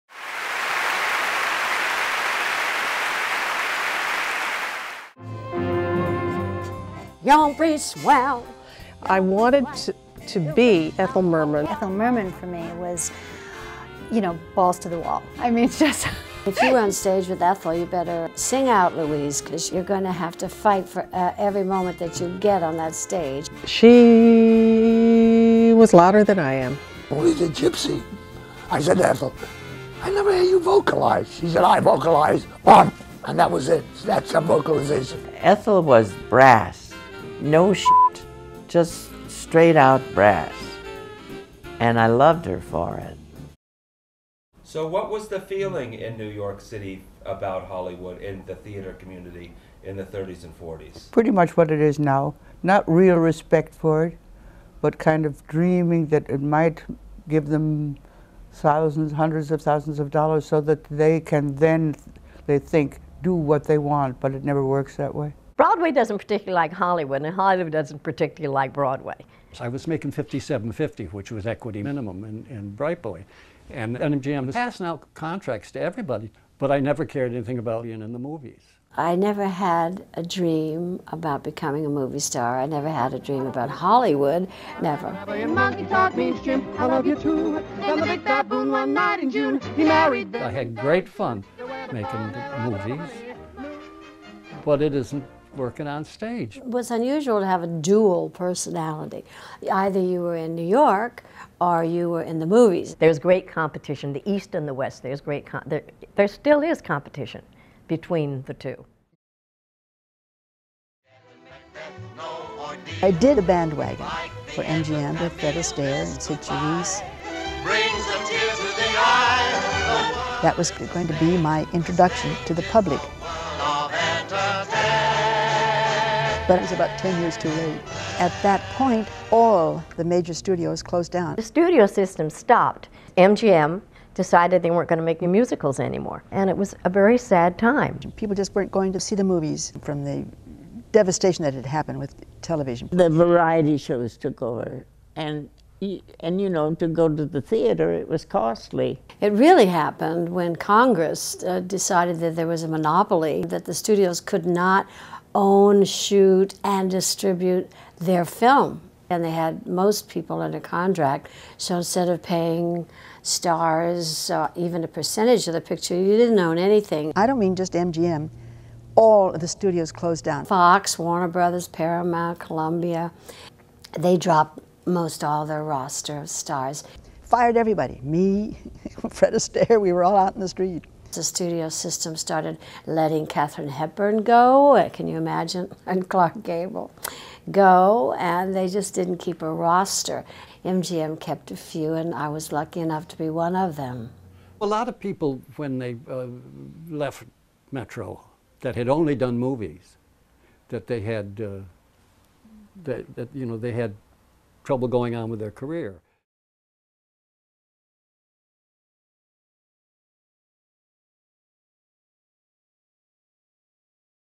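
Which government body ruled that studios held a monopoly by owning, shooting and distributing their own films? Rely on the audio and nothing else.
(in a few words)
Congress.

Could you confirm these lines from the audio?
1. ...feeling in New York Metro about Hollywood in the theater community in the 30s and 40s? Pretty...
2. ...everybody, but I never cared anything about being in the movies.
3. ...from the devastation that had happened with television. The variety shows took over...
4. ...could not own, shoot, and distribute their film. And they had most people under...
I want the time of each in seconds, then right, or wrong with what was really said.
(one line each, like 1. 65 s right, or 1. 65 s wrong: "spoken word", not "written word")
1. 45 s wrong: "City", not "Metro"
2. 75 s right
3. 139 s right
4. 154 s right.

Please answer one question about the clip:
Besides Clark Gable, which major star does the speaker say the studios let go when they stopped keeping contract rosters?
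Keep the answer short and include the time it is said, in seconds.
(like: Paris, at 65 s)
Katharine Hepburn, at 183 s.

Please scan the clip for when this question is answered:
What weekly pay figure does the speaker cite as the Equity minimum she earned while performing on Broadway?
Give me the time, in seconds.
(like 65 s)
70 s.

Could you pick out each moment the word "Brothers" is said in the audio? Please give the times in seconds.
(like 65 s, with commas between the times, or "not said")
171 s.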